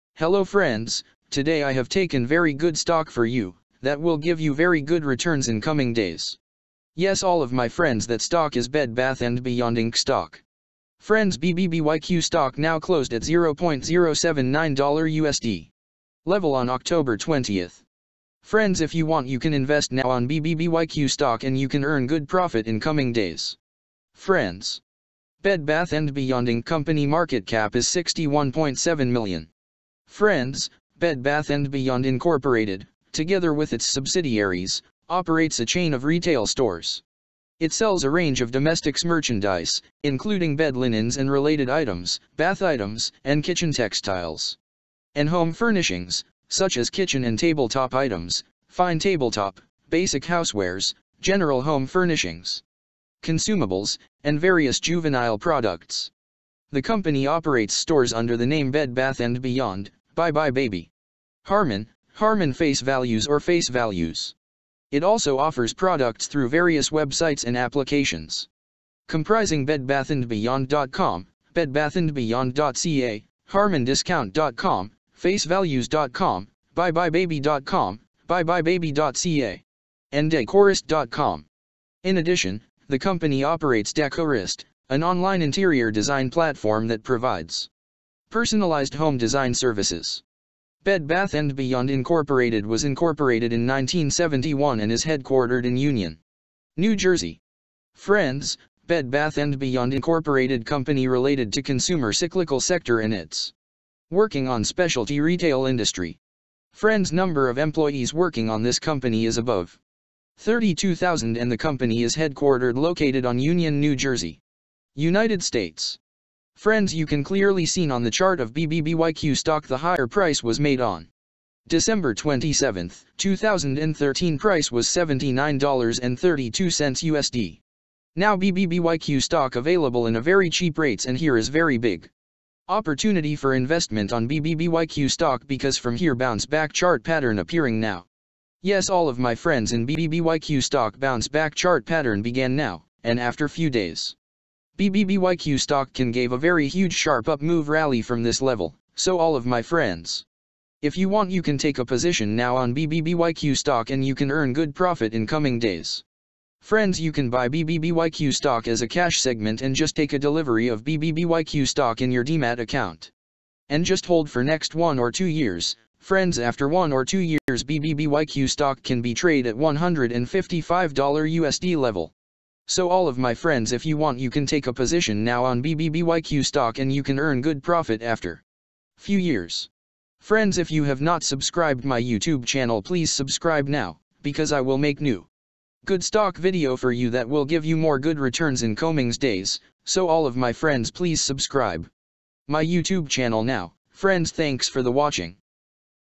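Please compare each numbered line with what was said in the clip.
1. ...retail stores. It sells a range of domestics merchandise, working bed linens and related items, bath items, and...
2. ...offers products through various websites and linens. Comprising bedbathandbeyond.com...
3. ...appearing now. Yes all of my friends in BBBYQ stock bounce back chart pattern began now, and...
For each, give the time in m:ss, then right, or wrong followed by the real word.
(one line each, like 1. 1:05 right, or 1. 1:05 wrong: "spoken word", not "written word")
1. 0:36 wrong: "including", not "working"
2. 1:05 wrong: "applications", not "linens"
3. 2:17 right.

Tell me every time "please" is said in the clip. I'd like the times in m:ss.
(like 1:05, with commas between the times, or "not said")
3:02, 3:10.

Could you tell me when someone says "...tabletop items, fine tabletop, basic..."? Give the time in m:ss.
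0:47.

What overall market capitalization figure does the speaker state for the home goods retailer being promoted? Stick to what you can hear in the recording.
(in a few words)
61.7 million.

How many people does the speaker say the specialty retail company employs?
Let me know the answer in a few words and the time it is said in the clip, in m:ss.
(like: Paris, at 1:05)
Above 32,000, at 1:49.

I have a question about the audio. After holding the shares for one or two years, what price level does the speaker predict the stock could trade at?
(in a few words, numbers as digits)
$155.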